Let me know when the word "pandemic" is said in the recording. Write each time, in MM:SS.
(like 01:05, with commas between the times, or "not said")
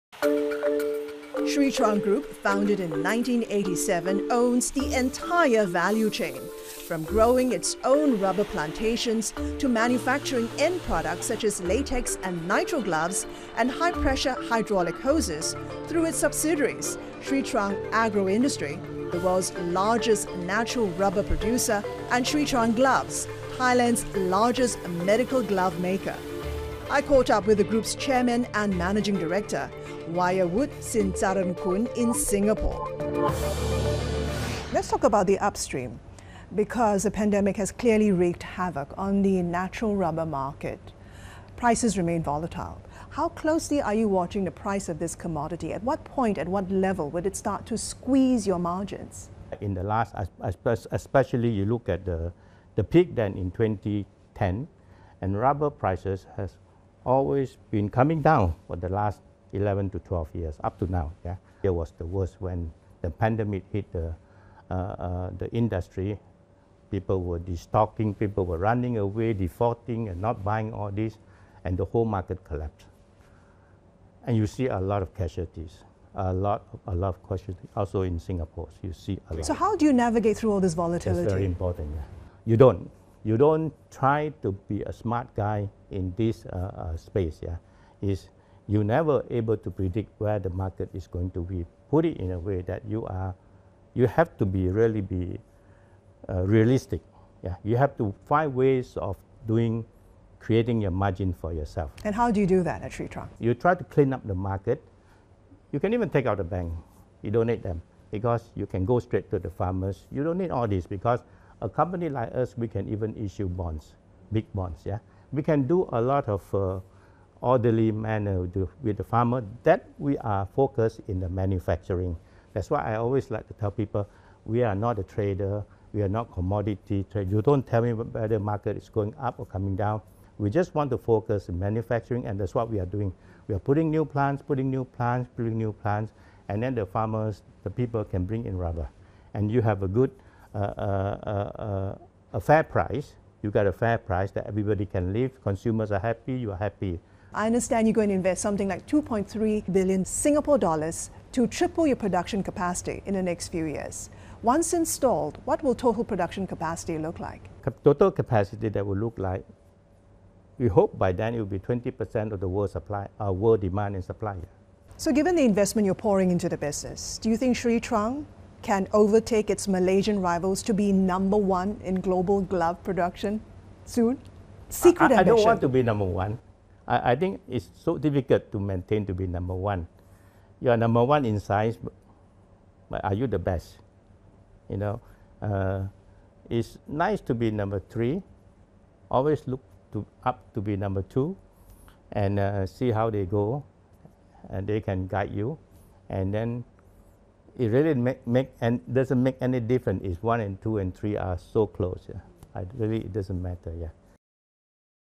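00:37, 01:03.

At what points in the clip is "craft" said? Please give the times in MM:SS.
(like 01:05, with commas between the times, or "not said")
not said.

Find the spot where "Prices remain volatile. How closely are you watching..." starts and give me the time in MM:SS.
00:41.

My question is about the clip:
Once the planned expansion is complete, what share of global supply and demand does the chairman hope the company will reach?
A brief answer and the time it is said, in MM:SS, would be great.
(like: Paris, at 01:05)
20%, at 02:41.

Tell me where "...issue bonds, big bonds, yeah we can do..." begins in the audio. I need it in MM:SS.
01:53.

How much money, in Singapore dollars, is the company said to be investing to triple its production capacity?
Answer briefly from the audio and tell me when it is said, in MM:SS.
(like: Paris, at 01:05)
2.3 billion Singapore dollars, at 02:28.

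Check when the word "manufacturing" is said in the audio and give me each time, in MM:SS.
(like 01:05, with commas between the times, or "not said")
00:09, 02:01, 02:11.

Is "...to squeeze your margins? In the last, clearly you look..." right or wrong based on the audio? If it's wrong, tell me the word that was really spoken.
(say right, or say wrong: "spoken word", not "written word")
wrong: "especially", not "clearly".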